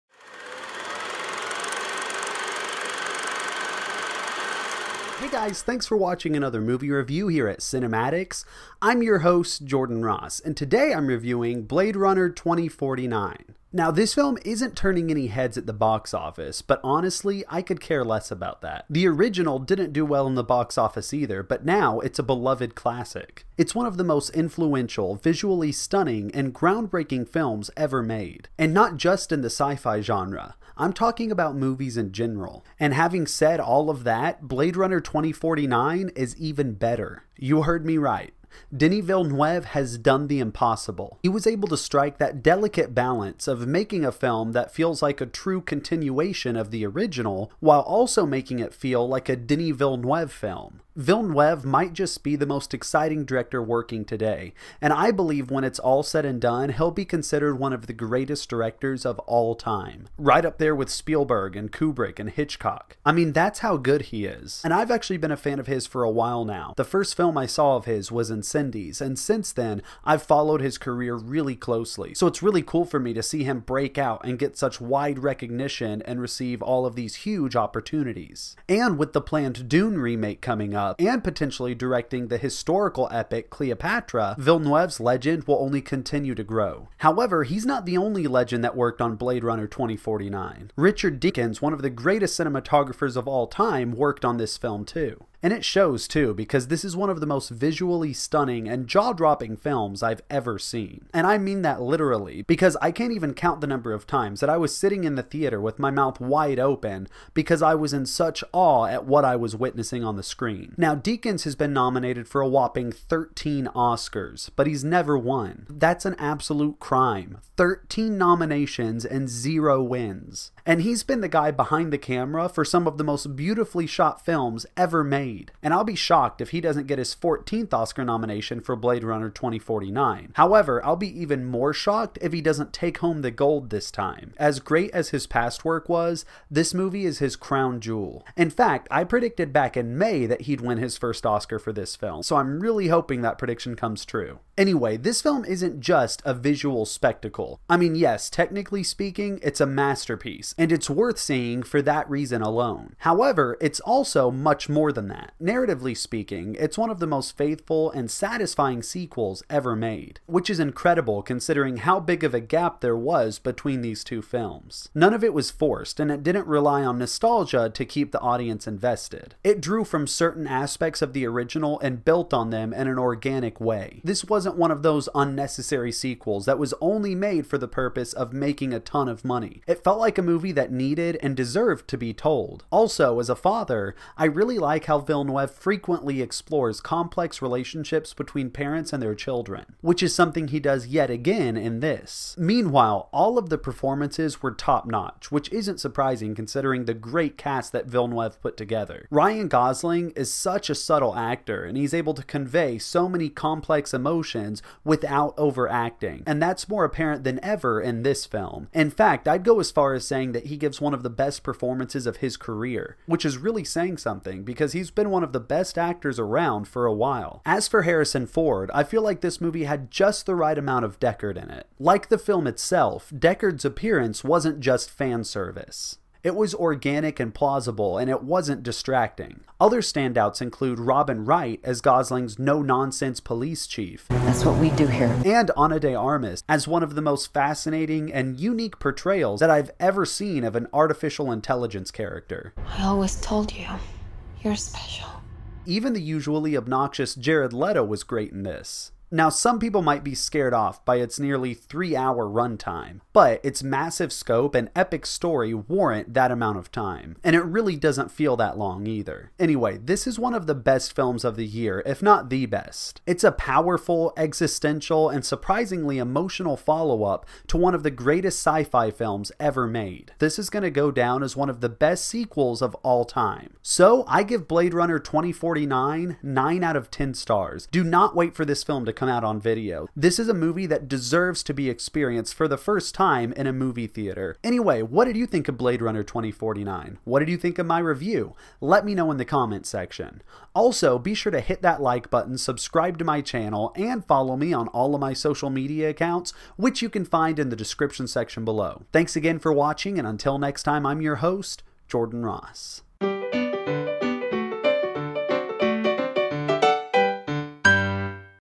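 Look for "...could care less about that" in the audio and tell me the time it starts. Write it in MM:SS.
00:17.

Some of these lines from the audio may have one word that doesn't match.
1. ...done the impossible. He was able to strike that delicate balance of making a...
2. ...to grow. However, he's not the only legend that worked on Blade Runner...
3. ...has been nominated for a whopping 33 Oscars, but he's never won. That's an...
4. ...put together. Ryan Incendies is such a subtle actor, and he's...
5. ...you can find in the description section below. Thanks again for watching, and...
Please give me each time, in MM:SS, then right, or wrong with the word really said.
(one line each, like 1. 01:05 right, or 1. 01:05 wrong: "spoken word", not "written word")
1. 00:39 right
2. 01:26 right
3. 01:51 wrong: "13", not "33"
4. 03:18 wrong: "Gosling", not "Incendies"
5. 04:56 right.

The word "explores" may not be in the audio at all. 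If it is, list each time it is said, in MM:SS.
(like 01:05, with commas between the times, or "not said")
03:06.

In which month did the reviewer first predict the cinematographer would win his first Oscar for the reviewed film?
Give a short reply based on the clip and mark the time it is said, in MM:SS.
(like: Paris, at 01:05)
May, at 02:19.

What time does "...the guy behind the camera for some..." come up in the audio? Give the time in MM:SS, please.
02:01.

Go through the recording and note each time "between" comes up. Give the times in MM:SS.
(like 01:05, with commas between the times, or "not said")
02:43, 03:08.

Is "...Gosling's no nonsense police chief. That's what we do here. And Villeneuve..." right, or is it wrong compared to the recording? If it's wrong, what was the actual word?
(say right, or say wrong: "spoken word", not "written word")
wrong: "Ana", not "Villeneuve".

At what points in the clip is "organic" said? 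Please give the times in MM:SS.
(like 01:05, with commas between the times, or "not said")
02:52, 03:46.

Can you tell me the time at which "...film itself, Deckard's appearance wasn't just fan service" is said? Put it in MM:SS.
03:42.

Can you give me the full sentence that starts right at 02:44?
None of it was forced, and it didn't rely on nostalgia to keep the audience invested.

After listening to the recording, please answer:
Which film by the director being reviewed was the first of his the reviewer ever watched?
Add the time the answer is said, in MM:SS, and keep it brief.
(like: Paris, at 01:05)
Incendies, at 01:08.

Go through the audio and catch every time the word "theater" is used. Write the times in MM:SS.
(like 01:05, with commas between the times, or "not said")
01:45, 04:43.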